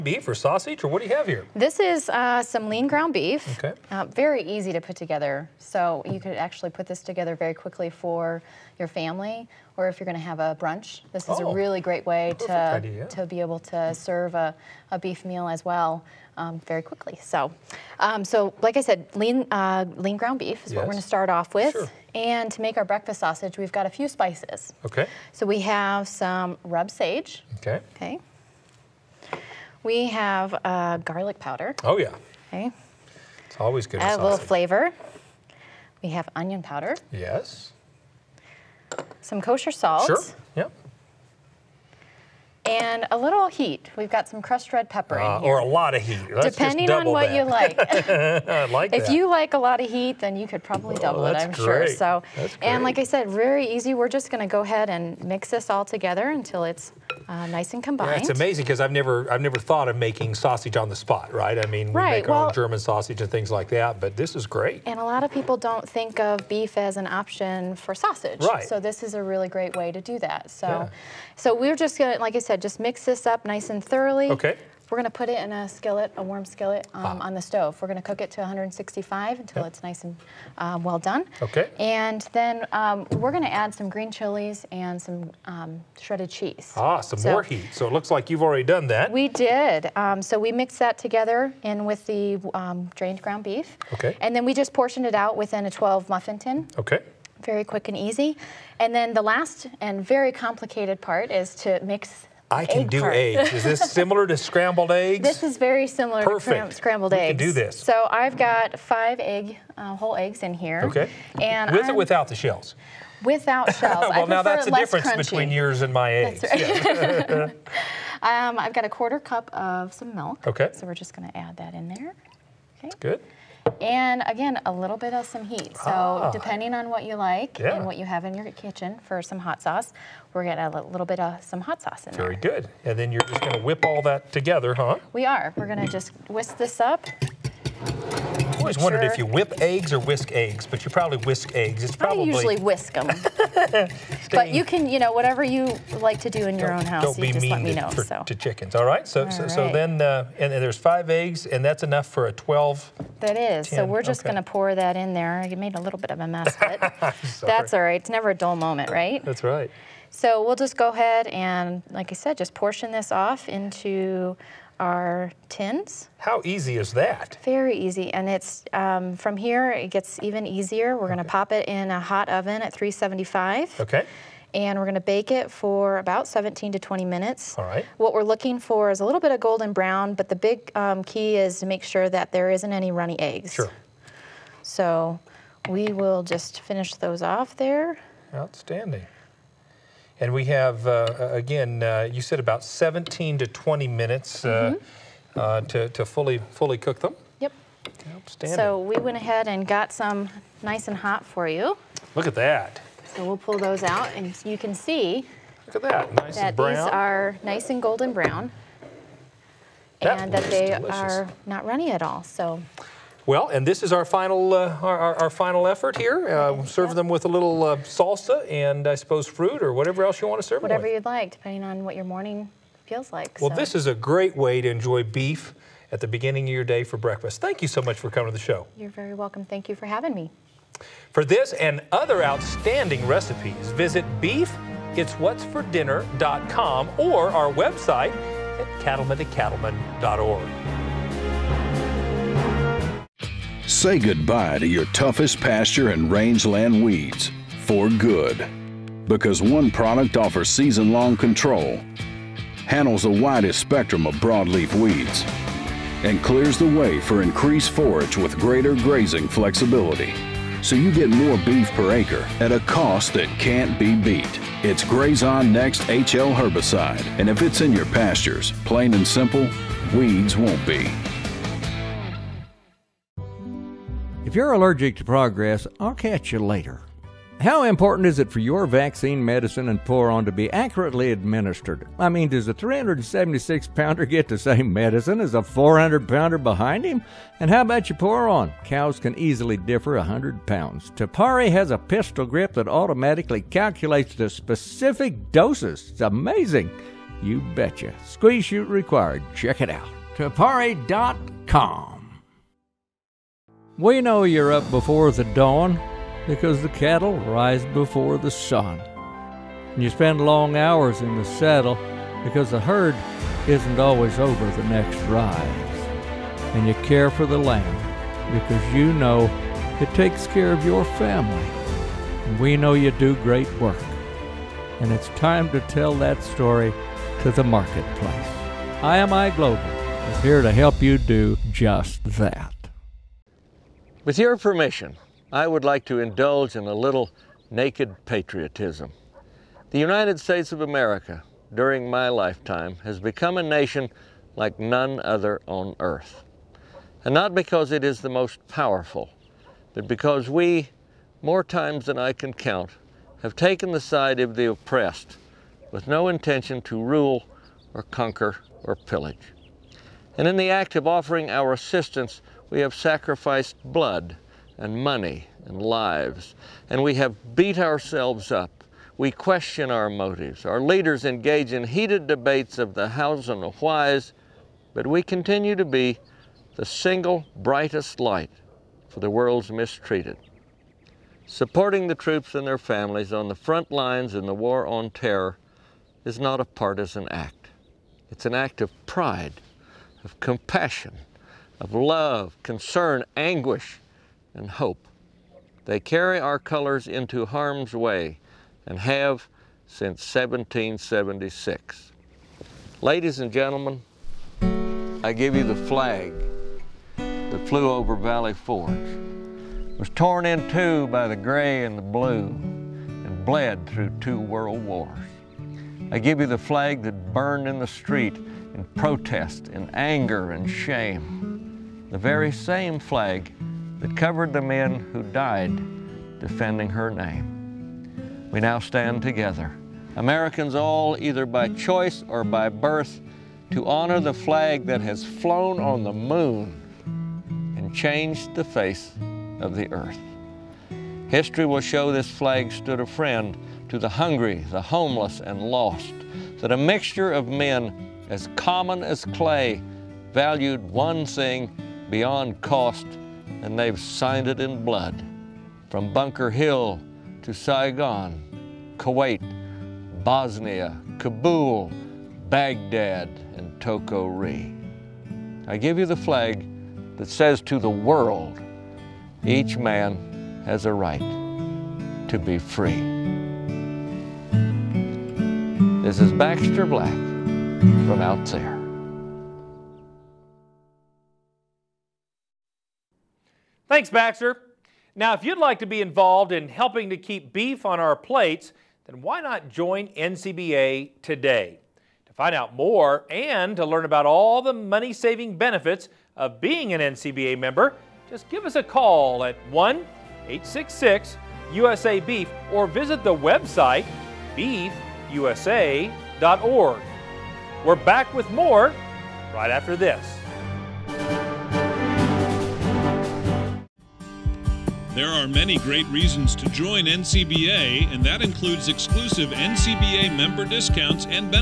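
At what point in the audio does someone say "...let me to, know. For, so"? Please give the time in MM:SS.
02:27.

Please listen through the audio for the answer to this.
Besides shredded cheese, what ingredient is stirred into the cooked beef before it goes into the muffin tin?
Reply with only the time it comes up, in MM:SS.
01:23.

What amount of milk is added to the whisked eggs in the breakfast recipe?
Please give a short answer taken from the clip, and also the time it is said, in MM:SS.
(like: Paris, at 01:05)
a quarter cup, at 01:58.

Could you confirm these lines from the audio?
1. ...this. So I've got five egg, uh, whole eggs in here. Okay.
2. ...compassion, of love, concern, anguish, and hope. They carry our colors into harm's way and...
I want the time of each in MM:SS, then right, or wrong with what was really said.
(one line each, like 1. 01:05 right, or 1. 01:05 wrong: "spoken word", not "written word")
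1. 01:47 right
2. 06:30 right.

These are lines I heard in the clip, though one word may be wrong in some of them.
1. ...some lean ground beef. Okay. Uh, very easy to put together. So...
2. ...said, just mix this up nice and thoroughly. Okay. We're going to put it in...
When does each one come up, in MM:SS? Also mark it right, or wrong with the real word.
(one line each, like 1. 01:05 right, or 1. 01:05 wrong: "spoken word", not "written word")
1. 00:02 right
2. 01:12 right.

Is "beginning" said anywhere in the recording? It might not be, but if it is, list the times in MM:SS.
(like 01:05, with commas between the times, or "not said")
03:46.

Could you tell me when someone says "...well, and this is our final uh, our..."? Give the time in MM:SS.
03:33.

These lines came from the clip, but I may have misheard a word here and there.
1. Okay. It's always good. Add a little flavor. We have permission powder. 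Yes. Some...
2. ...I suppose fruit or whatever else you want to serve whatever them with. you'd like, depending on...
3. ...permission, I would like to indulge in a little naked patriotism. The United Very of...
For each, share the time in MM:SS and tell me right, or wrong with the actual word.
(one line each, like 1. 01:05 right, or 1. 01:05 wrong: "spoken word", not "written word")
1. 00:32 wrong: "onion", not "permission"
2. 03:38 right
3. 05:34 wrong: "States", not "Very".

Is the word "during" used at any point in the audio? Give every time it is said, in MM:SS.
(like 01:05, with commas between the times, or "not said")
05:41.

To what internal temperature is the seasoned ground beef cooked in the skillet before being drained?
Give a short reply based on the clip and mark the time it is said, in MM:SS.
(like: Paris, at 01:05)
165, at 01:18.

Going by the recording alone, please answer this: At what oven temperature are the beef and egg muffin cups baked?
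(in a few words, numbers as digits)
375.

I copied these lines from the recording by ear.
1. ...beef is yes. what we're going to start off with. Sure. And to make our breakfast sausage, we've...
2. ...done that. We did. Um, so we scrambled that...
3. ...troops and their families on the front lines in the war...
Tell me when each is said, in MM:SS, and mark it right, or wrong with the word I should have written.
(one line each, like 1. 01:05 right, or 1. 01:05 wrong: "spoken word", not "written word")
1. 00:20 right
2. 01:28 wrong: "mixed", not "scrambled"
3. 06:21 right.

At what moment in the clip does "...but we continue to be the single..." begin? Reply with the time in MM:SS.
06:14.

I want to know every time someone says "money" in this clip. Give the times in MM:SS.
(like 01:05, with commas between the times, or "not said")
06:04, 08:14.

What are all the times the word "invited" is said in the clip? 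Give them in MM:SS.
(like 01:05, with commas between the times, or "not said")
not said.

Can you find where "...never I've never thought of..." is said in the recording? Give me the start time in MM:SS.
00:58.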